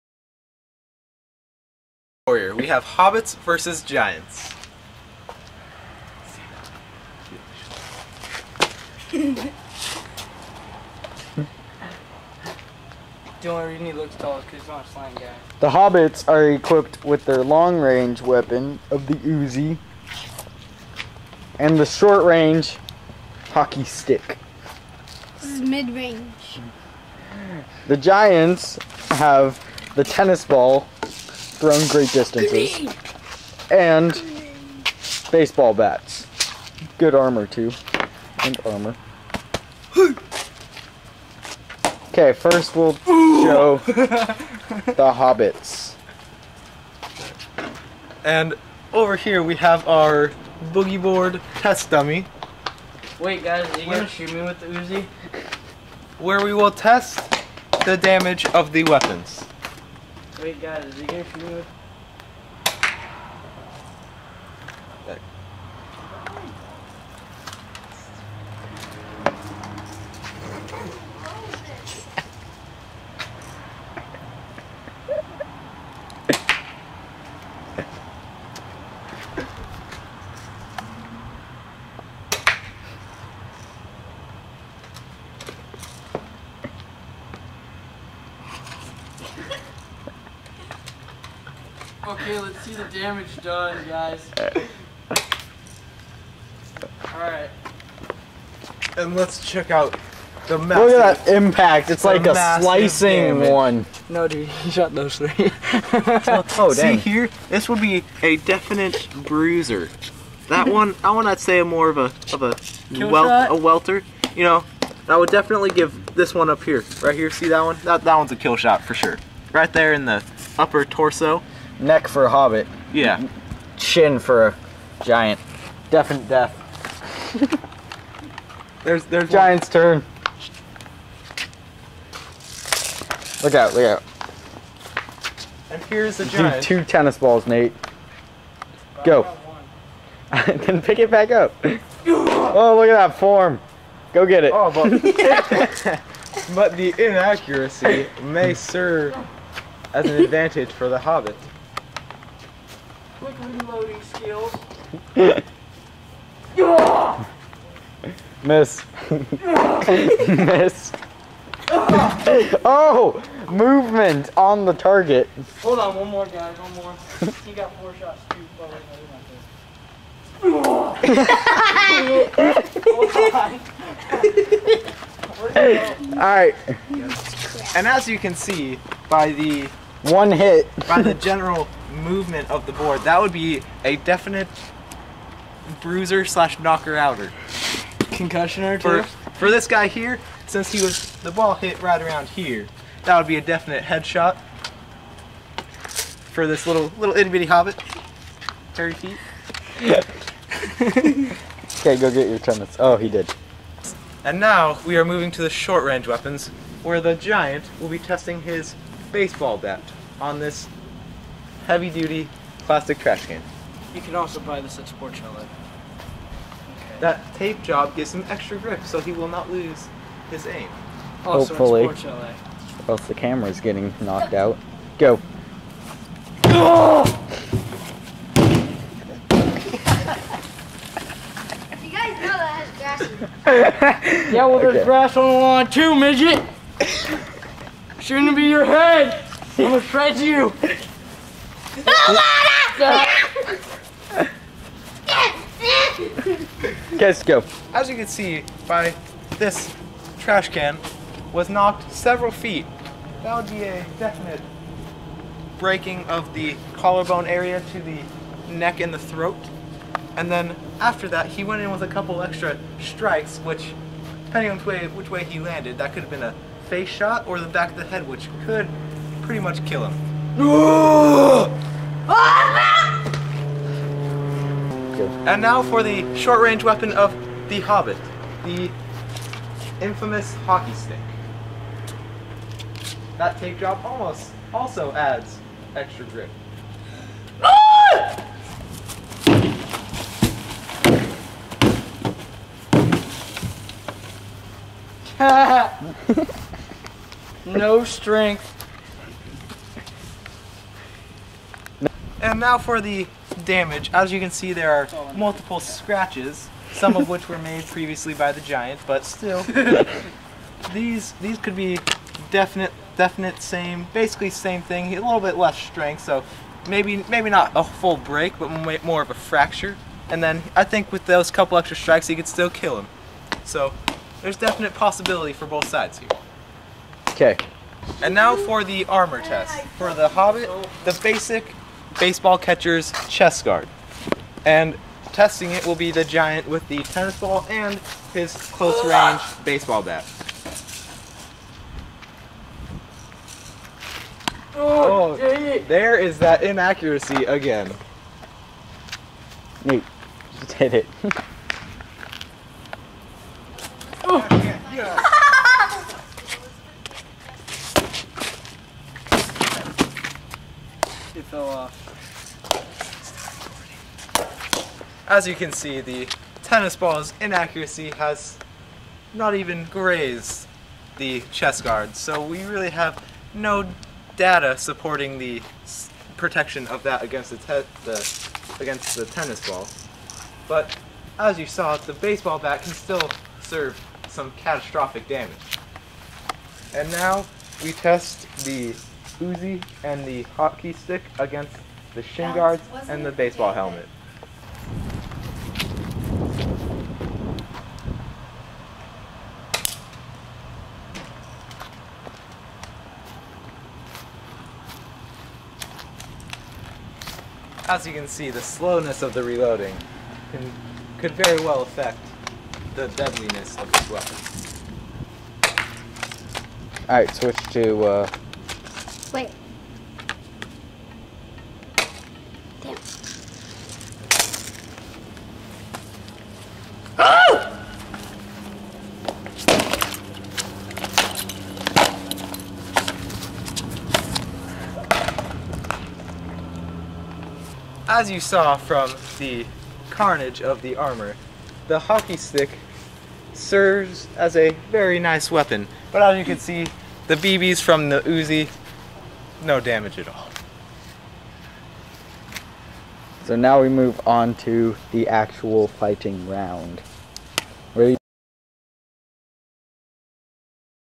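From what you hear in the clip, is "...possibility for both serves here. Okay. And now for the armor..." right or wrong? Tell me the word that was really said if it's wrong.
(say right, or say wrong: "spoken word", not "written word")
wrong: "sides", not "serves".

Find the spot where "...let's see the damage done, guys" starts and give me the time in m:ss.
1:32.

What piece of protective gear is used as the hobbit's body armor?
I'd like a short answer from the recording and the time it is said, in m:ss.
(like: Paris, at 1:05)
baseball catcher's chest guard, at 5:31.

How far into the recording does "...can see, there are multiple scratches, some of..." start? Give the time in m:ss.
5:04.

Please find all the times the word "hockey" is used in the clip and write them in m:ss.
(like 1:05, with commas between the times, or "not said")
0:23, 4:40, 6:30, 7:21.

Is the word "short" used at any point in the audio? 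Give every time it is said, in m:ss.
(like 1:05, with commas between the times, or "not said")
0:21, 3:25, 4:36.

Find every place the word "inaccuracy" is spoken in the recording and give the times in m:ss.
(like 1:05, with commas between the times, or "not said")
2:26, 5:46, 6:07.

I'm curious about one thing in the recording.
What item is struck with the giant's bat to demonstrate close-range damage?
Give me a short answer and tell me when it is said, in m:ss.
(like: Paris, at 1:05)
heavy duty plastic trash can, at 3:31.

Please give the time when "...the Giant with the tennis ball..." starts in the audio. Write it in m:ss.
5:35.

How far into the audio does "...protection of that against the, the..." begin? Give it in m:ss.
6:16.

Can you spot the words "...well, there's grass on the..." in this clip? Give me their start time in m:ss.
3:54.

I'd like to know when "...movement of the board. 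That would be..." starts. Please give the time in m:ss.
3:01.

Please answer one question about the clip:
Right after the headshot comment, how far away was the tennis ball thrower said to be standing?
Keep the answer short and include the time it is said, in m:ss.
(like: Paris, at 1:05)
30 feet, at 3:18.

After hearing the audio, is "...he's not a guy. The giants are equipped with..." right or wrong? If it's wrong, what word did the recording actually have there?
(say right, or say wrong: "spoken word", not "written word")
wrong: "hobbits", not "giants".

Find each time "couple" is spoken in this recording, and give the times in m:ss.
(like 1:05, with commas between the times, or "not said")
4:21, 5:21.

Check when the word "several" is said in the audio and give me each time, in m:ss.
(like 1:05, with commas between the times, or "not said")
4:11.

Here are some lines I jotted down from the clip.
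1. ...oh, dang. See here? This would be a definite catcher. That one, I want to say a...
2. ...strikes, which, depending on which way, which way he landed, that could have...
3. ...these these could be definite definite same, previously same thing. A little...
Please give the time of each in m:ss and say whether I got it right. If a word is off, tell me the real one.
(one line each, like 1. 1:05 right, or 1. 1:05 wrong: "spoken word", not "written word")
1. 1:45 wrong: "bruiser", not "catcher"
2. 4:22 right
3. 5:10 wrong: "basically", not "previously".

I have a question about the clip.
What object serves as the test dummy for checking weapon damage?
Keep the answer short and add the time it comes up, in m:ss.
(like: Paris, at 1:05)
boogie board, at 0:50.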